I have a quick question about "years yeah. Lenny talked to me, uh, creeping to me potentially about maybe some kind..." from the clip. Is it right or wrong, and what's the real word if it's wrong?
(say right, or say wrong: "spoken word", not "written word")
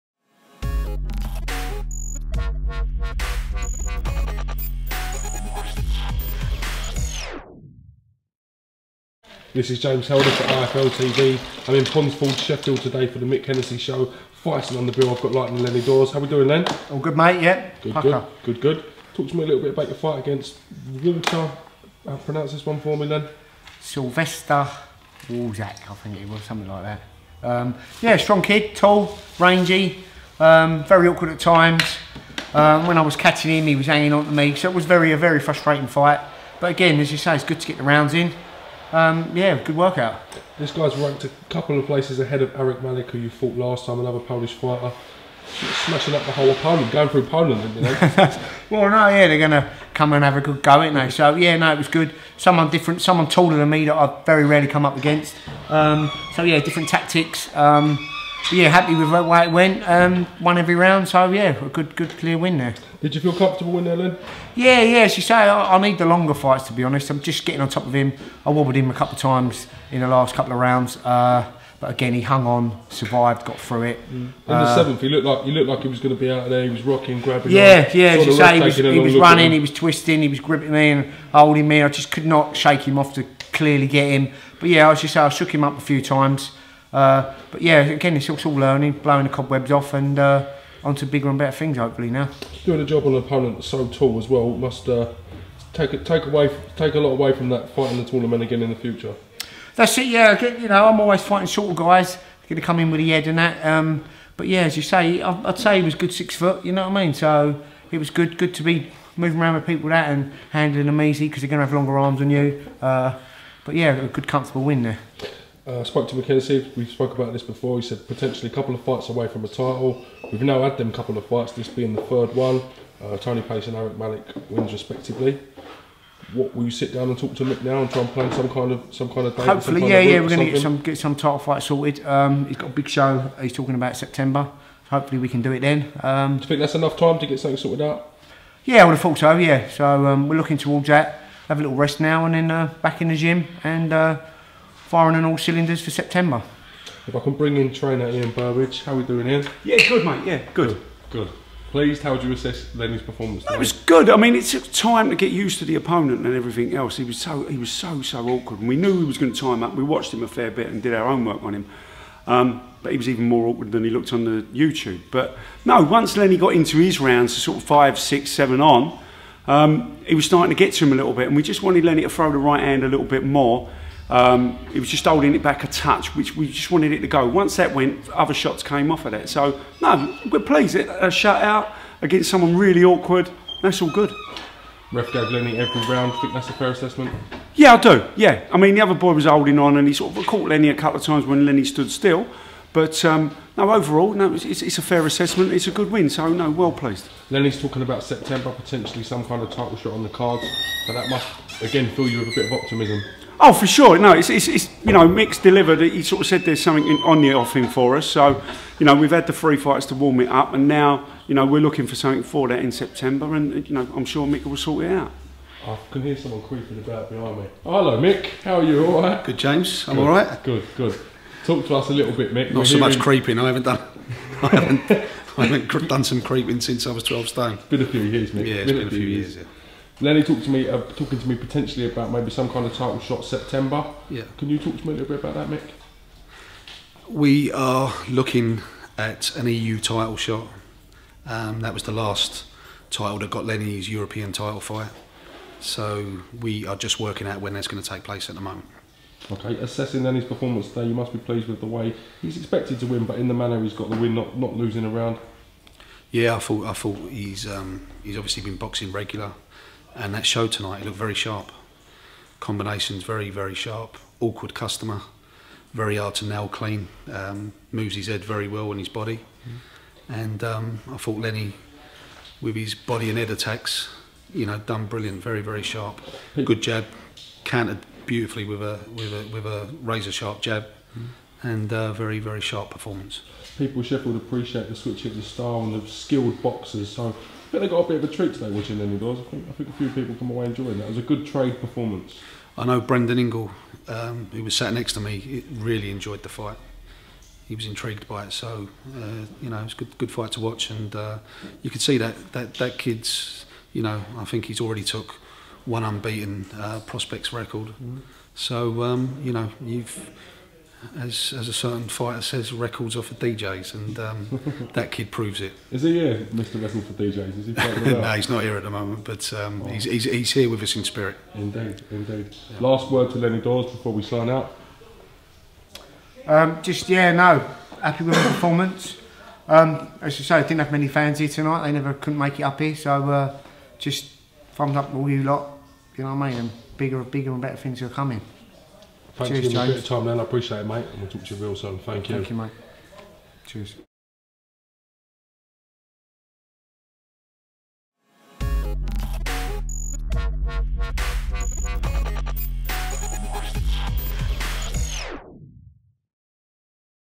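wrong: "talking", not "creeping".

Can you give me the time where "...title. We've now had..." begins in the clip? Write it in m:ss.
1:59.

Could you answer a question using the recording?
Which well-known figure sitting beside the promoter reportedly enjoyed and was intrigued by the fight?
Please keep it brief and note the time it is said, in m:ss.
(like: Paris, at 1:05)
Brendan Ingle, at 4:52.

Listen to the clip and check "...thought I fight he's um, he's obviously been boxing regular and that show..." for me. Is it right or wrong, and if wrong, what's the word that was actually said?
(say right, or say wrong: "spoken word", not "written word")
wrong: "thought", not "fight".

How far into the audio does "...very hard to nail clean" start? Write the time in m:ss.
4:25.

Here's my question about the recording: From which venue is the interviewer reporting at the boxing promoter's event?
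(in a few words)
Ponds Forge.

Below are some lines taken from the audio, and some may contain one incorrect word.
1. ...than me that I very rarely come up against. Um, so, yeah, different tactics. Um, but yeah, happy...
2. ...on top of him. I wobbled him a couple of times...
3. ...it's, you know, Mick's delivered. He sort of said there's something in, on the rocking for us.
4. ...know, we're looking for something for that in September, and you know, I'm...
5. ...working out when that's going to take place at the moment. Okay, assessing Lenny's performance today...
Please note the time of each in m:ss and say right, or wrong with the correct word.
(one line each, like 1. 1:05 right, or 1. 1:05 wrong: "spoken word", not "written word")
1. 0:53 right
2. 1:07 right
3. 3:24 wrong: "offing", not "rocking"
4. 3:31 right
5. 4:06 right.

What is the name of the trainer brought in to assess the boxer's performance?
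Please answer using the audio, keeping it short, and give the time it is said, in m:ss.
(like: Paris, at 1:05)
Ian Burbridge, at 2:28.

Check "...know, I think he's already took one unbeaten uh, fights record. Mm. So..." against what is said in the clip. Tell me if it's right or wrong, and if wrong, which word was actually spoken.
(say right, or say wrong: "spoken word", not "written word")
wrong: "prospects", not "fights".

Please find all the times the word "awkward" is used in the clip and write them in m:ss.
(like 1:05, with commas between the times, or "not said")
0:31, 2:38, 2:43, 3:02, 4:24.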